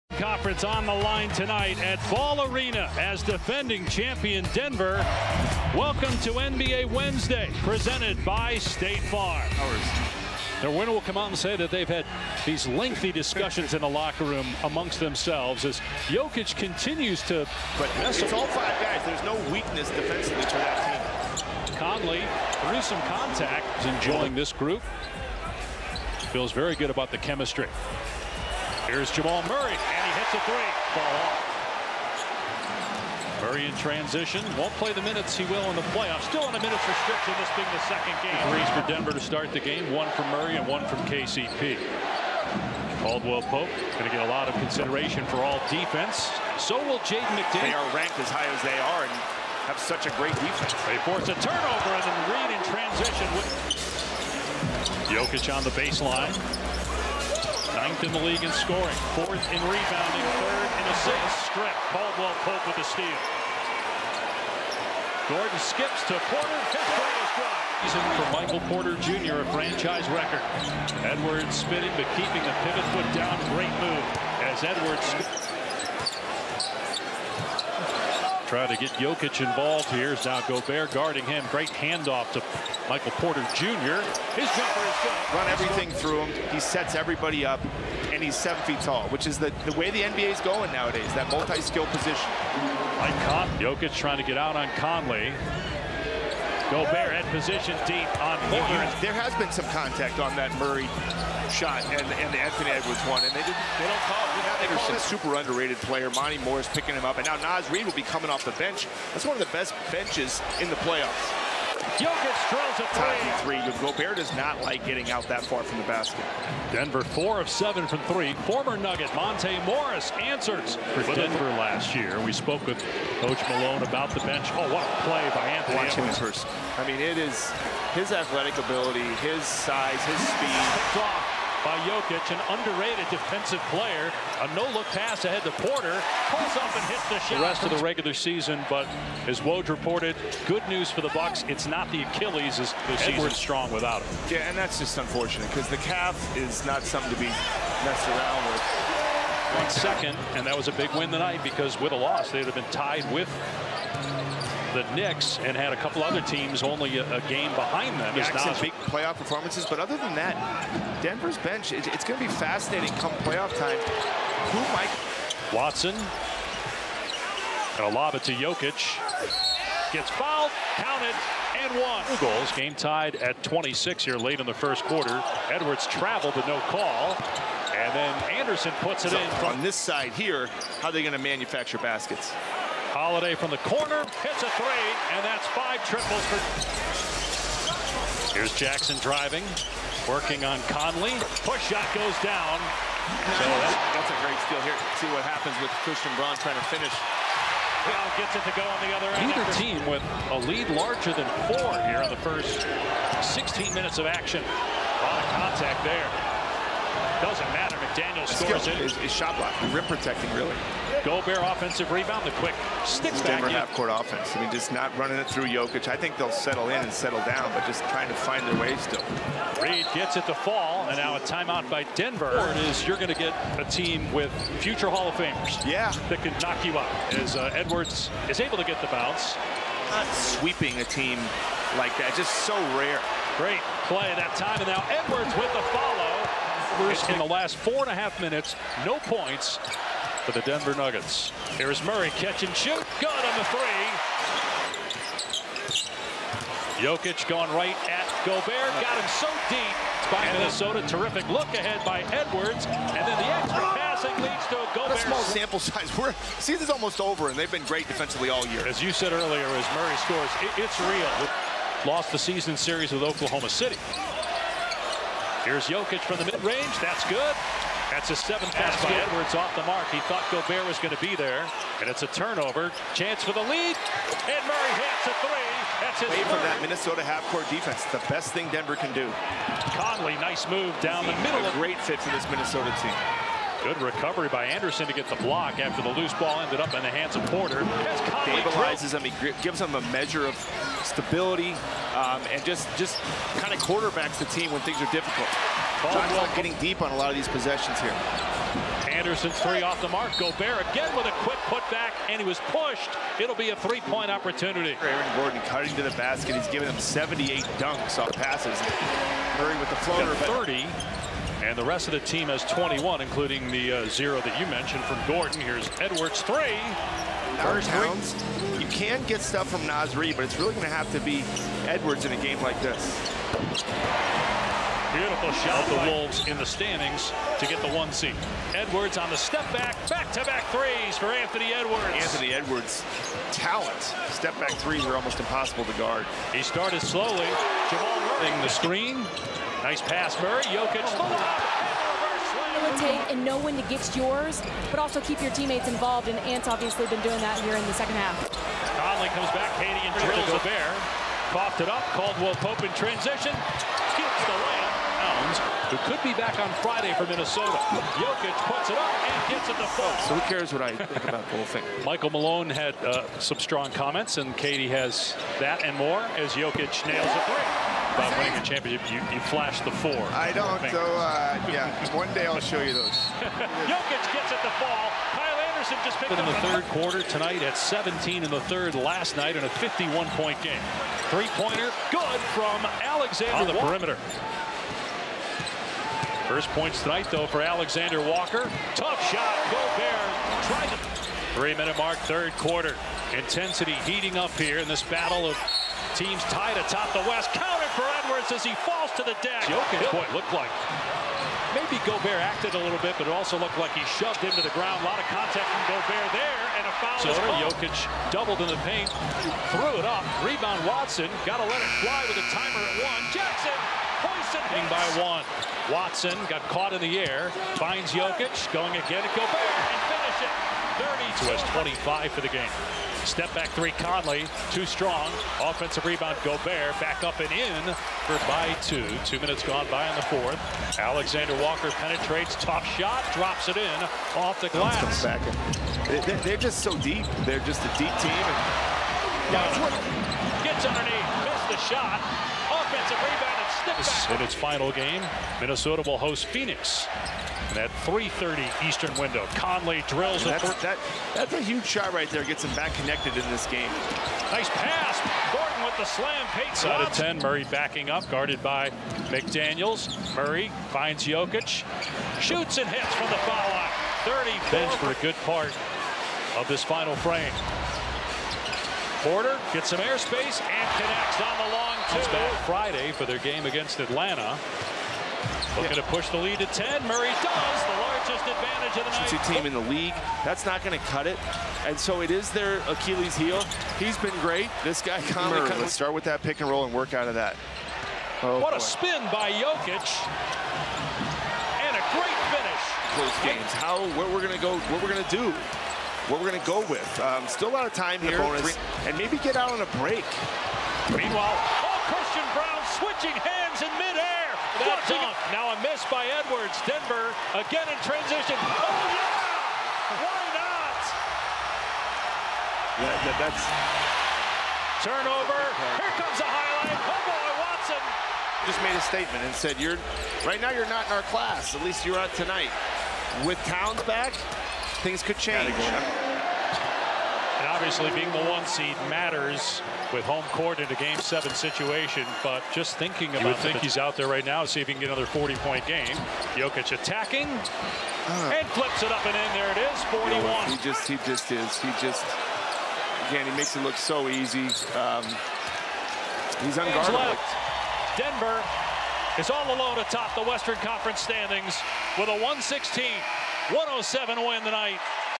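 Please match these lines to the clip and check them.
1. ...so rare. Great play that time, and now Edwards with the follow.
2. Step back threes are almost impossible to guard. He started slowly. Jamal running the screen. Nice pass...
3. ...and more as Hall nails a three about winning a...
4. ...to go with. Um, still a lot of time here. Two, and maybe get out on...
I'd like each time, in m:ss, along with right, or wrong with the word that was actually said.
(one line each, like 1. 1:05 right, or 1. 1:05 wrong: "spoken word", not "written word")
1. 3:52 right
2. 5:34 right
3. 6:05 wrong: "Jokic", not "Hall"
4. 8:16 wrong: "Three", not "Two".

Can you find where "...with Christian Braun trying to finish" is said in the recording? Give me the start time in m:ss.
3:15.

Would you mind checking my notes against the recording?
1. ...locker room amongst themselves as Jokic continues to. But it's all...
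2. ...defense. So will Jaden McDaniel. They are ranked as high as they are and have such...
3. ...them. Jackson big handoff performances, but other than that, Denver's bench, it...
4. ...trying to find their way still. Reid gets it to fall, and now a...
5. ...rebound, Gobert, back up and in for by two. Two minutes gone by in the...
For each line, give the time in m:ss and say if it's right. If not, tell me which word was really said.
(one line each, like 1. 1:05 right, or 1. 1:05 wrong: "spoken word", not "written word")
1. 0:13 right
2. 0:45 right
3. 2:37 wrong: "playoff", not "handoff"
4. 3:37 right
5. 7:05 right.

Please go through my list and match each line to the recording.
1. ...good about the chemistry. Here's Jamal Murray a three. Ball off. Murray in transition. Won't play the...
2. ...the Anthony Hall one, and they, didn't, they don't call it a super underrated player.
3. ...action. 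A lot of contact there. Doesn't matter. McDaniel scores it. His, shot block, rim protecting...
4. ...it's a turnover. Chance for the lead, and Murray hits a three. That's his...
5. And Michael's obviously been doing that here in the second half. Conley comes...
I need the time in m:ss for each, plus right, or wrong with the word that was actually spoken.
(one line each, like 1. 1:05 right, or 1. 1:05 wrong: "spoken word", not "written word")
1. 0:26 right
2. 1:42 wrong: "Edwards", not "Hall"
3. 3:24 right
4. 4:31 right
5. 5:46 wrong: "Ant", not "Michael".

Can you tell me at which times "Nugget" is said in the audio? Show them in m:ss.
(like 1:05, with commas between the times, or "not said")
1:58, 4:00.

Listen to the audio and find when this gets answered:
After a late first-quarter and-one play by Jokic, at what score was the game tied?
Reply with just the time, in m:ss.
2:53.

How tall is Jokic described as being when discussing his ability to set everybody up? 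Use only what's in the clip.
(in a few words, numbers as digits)
Seven feet.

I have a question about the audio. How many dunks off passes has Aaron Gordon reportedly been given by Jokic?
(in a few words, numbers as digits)
78.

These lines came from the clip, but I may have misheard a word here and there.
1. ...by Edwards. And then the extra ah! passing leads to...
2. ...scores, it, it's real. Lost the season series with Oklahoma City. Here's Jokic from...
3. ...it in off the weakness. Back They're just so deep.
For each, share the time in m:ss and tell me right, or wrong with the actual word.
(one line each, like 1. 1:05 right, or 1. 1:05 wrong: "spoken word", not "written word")
1. 4:11 right
2. 4:19 right
3. 7:13 wrong: "glass", not "weakness".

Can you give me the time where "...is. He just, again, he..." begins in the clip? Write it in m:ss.
9:01.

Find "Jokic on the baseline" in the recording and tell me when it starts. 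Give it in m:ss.
0:55.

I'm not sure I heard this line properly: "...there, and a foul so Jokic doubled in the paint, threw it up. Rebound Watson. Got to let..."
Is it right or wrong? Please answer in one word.
right.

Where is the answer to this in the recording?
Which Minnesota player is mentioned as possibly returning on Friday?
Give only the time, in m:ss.
5:55.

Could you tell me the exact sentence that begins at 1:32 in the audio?
Mike Con Jokic trying to get out on Conley.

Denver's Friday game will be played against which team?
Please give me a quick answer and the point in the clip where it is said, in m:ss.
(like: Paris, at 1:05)
Atlanta, at 7:53.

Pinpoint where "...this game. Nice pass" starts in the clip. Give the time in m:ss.
7:33.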